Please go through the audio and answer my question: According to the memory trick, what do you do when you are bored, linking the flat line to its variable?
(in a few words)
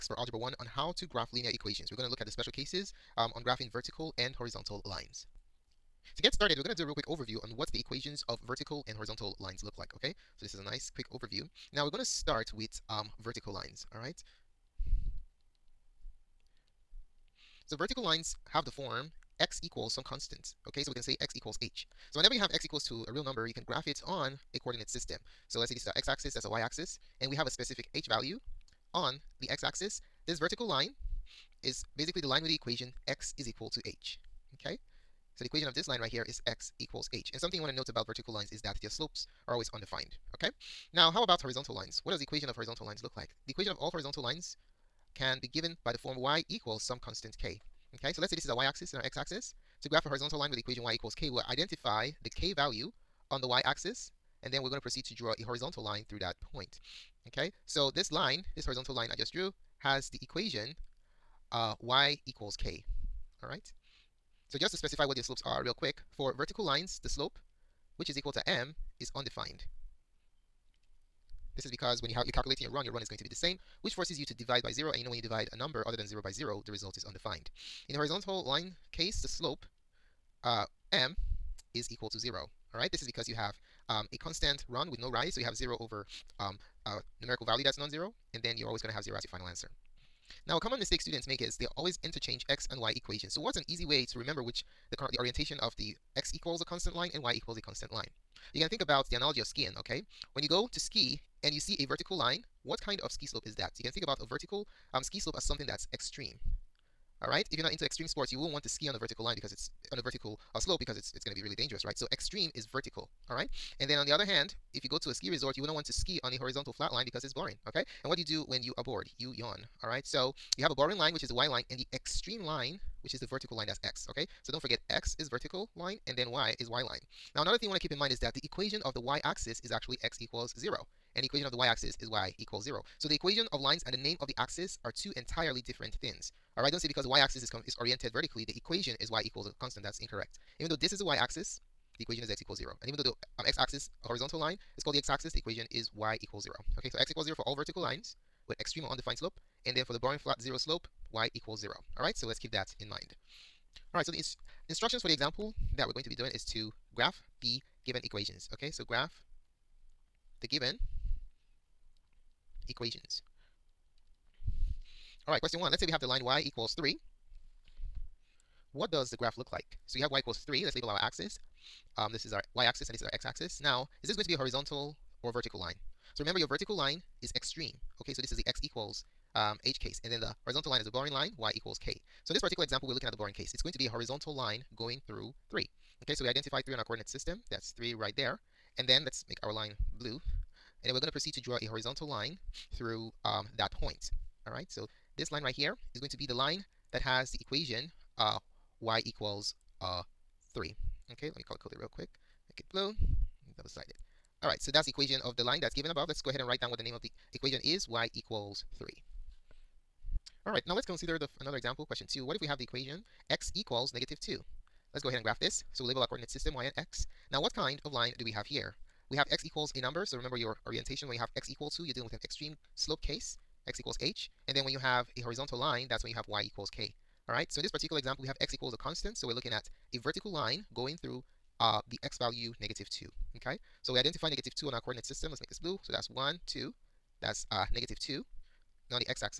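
Yawn.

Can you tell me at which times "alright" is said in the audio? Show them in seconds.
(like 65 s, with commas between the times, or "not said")
82 s, 107 s, 113 s, 136 s, 204 s, 210 s, 227 s.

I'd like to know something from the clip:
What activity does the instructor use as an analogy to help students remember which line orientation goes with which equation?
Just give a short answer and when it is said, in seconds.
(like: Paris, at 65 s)
Skiing, at 99 s.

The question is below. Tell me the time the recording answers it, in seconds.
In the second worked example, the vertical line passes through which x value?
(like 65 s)
213 s.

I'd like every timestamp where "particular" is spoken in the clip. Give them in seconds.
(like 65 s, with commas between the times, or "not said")
182 s, 227 s.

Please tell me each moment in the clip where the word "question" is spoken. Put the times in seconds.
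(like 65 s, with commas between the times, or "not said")
165 s, 211 s.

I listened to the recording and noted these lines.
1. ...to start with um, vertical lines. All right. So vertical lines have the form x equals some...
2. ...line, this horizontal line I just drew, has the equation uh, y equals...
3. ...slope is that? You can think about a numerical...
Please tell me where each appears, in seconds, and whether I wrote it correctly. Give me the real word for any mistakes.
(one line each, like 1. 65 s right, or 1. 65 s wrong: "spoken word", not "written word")
1. 11 s right
2. 58 s right
3. 103 s wrong: "vertical", not "numerical".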